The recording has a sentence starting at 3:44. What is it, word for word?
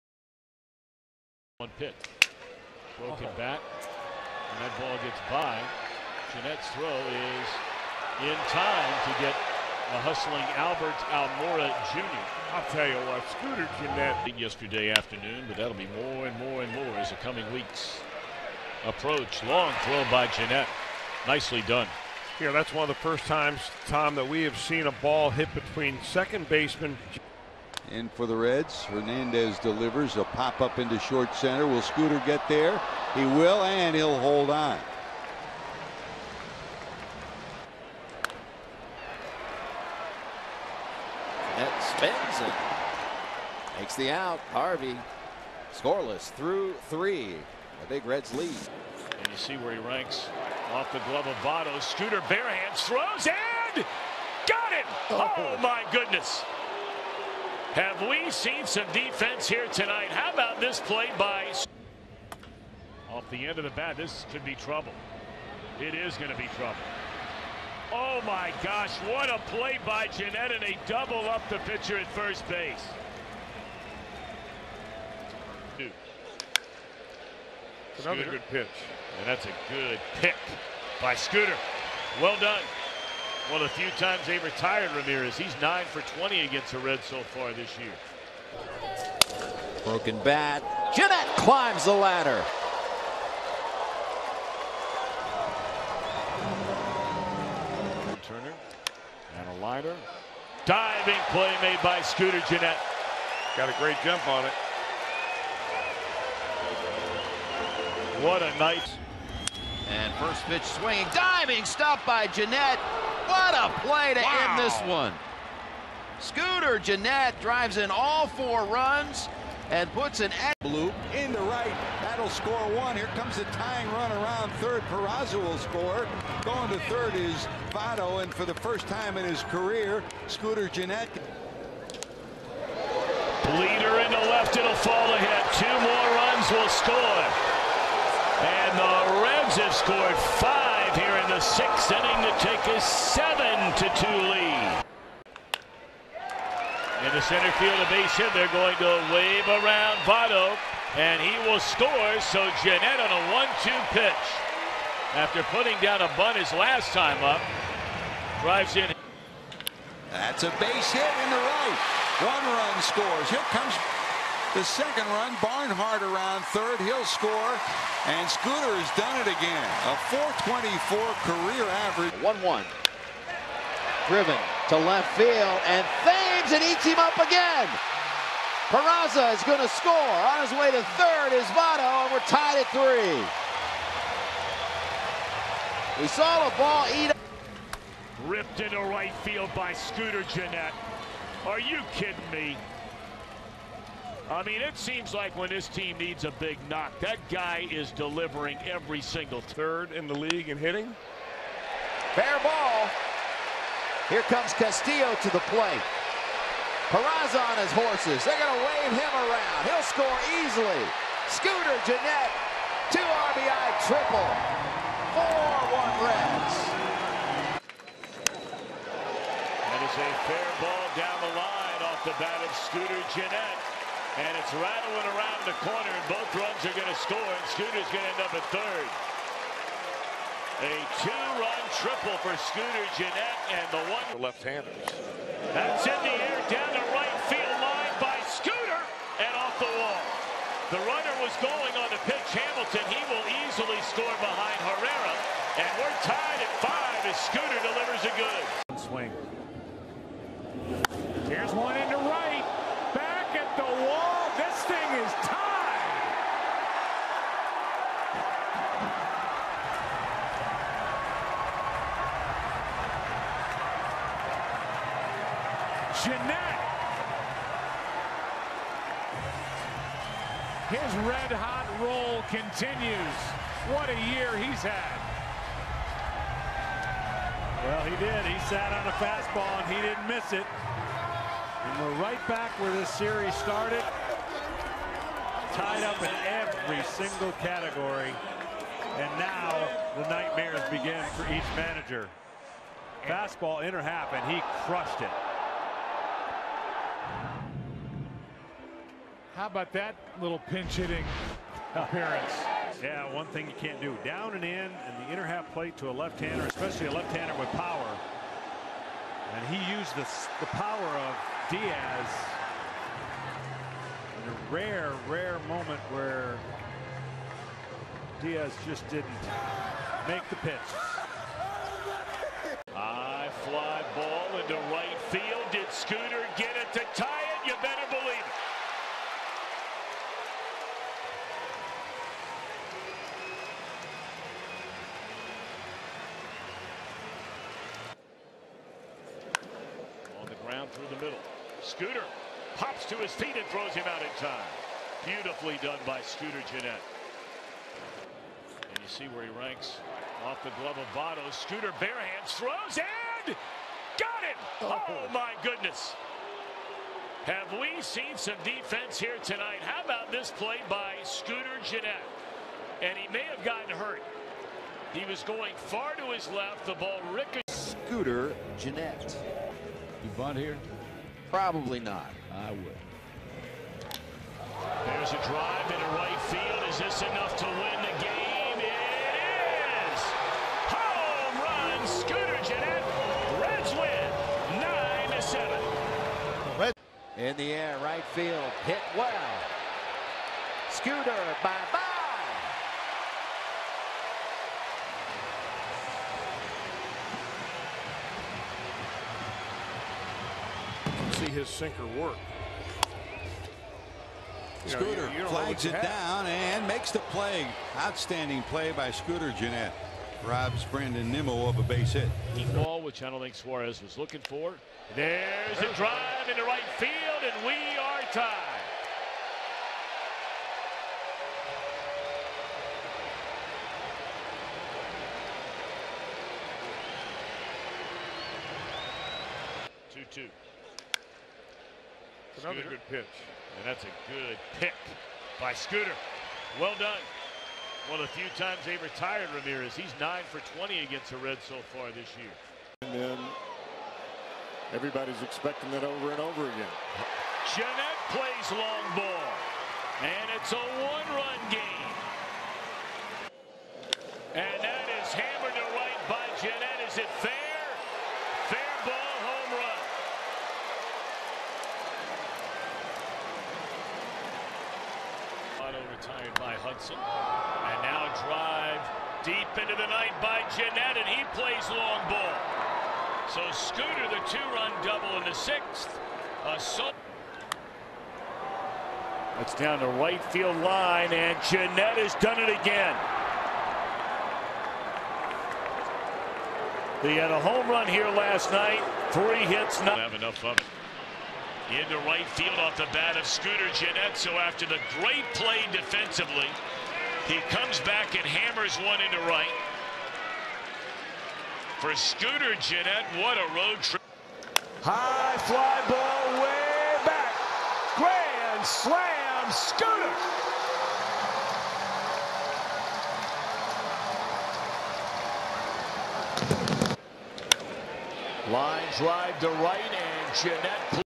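And it's rattling around the corner, and both runs are going to score, and Scooter's going to end up at third.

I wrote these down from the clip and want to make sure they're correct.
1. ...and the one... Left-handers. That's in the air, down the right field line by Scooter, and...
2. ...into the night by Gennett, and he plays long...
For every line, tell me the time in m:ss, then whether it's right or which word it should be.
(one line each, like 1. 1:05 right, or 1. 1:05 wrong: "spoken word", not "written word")
1. 3:53 right
2. 7:49 right.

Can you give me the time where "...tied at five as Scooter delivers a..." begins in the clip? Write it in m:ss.
4:06.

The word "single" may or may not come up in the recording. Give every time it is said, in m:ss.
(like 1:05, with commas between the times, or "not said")
3:19, 4:46.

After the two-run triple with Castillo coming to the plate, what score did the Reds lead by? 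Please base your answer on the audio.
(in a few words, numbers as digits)
4-1.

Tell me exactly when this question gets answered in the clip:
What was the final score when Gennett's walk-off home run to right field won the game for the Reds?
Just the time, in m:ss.
6:24.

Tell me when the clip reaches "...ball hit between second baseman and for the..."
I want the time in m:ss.
0:24.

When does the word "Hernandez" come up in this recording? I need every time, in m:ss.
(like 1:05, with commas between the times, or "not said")
0:28.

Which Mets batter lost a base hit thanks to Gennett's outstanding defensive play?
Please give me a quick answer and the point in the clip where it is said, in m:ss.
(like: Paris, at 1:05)
Brandon Nimmo, at 6:50.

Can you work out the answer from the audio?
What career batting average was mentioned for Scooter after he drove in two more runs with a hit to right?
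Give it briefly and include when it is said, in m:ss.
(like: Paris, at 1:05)
.424, at 2:50.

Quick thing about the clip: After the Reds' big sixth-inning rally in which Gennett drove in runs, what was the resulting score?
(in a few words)
7 to 2.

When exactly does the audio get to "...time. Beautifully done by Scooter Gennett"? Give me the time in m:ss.
5:44.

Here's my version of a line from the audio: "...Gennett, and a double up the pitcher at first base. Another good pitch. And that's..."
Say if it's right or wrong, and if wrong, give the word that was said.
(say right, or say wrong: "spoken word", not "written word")
right.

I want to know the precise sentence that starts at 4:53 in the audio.
Fastball inner half, and he crushed it.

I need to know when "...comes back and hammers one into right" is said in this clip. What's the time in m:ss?
8:17.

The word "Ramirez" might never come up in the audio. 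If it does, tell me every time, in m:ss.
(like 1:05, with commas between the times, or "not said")
1:24, 7:19.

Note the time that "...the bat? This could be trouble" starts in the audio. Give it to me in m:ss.
1:03.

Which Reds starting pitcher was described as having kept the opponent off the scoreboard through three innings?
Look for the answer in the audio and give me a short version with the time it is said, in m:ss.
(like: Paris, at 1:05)
Harvey, at 0:44.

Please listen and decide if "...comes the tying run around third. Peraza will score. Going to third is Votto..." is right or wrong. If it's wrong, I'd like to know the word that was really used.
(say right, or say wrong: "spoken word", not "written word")
right.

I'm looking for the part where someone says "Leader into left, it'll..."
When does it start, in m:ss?
2:13.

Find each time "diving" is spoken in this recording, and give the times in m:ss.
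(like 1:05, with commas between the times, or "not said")
1:40, 1:51.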